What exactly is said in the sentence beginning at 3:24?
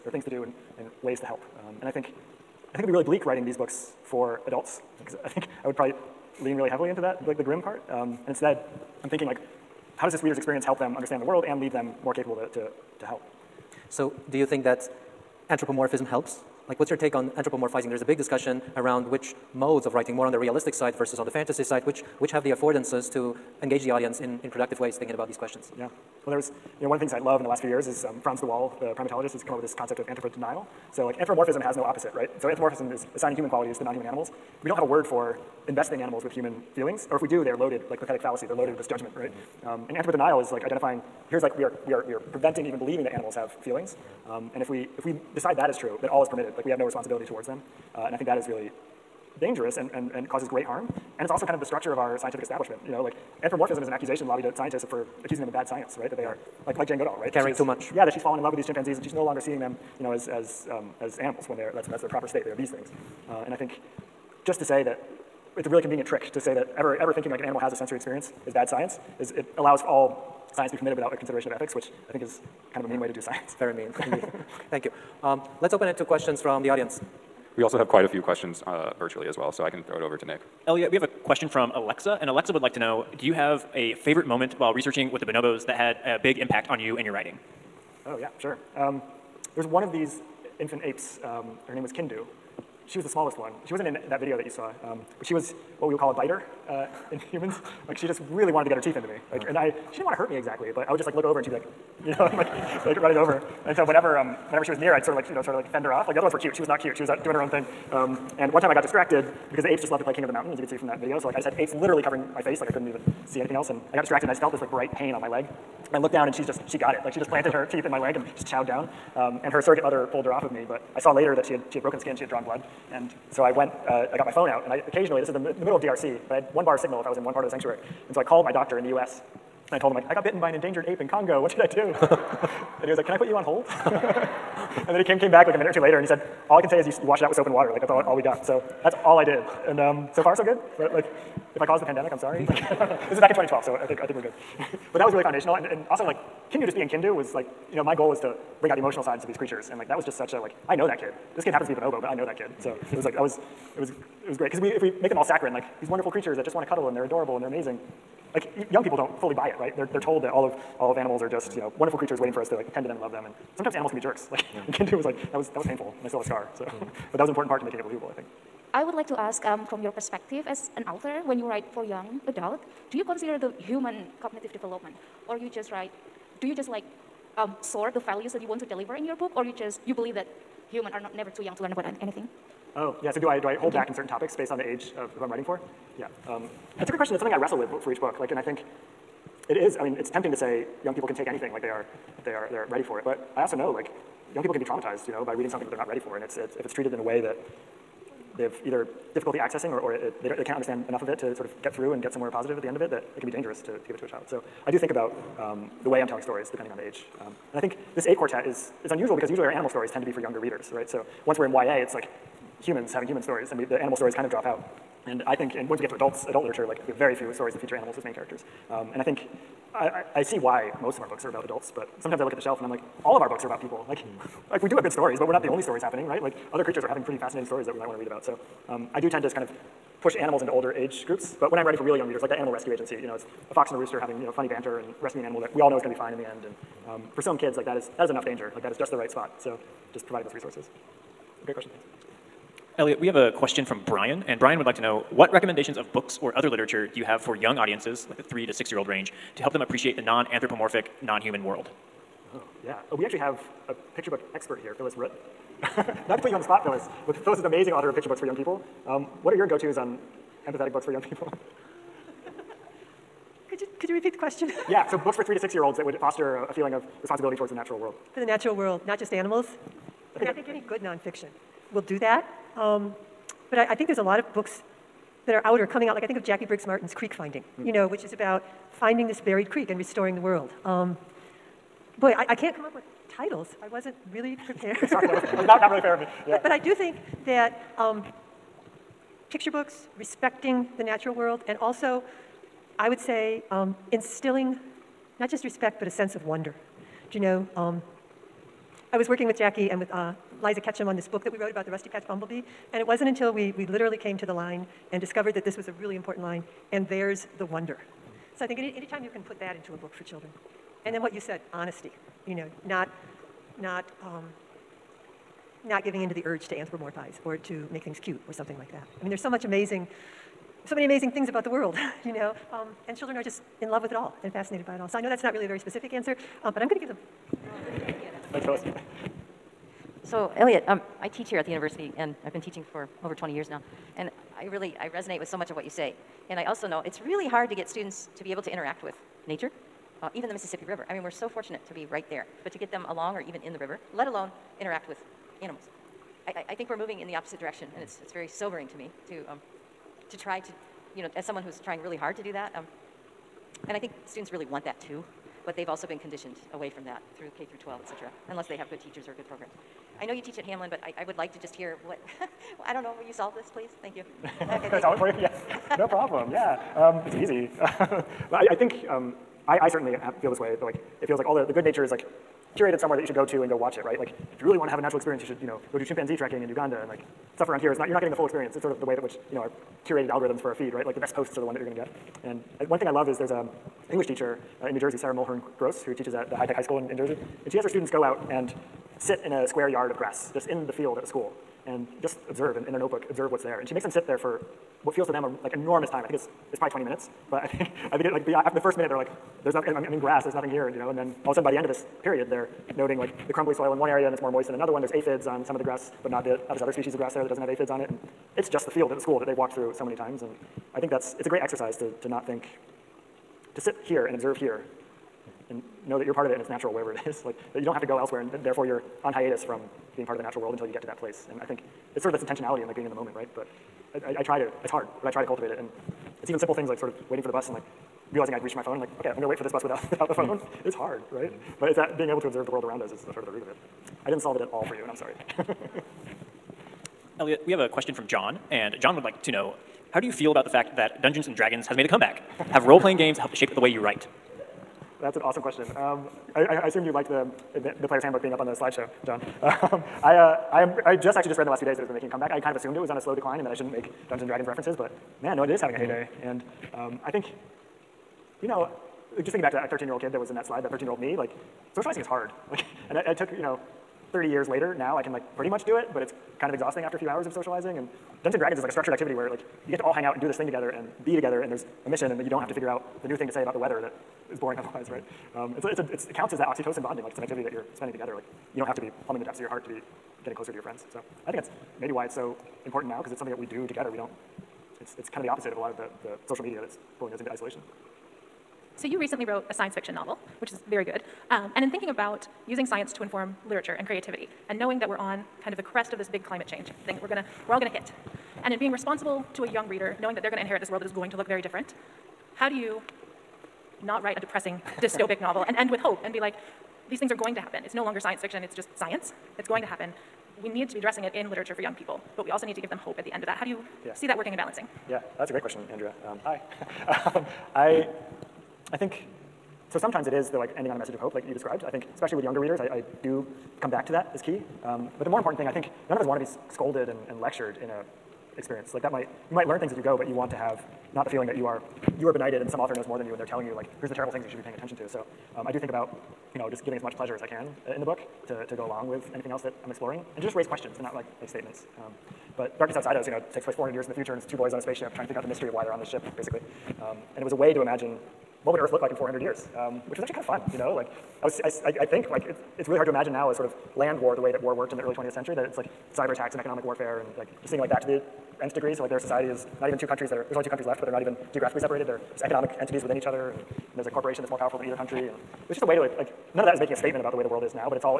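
So I do think about um, the way I'm telling stories depending on the age.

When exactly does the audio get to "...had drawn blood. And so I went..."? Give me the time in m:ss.
2:02.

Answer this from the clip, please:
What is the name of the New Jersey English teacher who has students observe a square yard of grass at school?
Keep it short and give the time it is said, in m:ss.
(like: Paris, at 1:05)
Sarah Mulhern Gross, at 6:24.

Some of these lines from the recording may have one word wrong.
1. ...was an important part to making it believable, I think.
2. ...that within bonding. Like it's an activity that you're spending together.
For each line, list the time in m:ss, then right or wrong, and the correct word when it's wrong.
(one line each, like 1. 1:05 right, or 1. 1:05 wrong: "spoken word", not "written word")
1. 2:47 right
2. 7:56 wrong: "oxytocin", not "within".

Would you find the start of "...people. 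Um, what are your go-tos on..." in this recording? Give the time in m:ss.
4:18.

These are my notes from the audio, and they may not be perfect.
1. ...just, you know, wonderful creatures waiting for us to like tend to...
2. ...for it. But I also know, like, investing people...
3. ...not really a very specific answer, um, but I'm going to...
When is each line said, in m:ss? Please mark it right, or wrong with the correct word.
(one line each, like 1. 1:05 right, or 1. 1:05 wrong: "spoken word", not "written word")
1. 2:41 right
2. 3:12 wrong: "young", not "investing"
3. 5:25 right.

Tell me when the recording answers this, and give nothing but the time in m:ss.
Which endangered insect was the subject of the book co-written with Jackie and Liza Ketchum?
5:01.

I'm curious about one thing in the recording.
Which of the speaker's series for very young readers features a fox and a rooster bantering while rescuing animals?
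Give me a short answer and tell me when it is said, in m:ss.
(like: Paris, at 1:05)
Animal Rescue Agency, at 3:52.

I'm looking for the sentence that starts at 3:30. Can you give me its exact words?
So once we're in YA, it's like humans having human stories and we, the animal stories kind of drop out.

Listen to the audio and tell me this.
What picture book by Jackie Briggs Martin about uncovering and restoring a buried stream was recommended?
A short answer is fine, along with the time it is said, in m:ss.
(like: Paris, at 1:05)
Creek Finding, at 4:36.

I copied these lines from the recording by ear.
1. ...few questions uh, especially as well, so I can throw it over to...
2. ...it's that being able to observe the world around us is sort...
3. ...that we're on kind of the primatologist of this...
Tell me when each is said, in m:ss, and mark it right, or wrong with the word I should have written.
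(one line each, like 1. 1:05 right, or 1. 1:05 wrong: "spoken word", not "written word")
1. 1:18 wrong: "virtually", not "especially"
2. 7:11 right
3. 8:14 wrong: "crest", not "primatologist".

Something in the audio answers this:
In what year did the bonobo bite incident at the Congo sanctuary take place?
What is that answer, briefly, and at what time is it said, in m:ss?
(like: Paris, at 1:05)
2012, at 2:23.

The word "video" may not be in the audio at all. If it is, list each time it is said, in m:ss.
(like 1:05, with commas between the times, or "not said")
1:34, 1:50.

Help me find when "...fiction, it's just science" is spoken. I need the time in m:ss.
8:28.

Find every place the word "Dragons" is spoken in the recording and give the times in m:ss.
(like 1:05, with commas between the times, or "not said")
7:21, 7:34, 7:48.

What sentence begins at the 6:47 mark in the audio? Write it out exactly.
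And it's just the field at the school that they've walked through so many times.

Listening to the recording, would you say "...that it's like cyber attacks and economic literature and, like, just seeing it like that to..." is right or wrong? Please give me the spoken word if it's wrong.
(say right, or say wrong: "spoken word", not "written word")
wrong: "warfare", not "literature".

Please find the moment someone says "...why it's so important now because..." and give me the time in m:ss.
8:01.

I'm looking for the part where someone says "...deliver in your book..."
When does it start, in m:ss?
2:58.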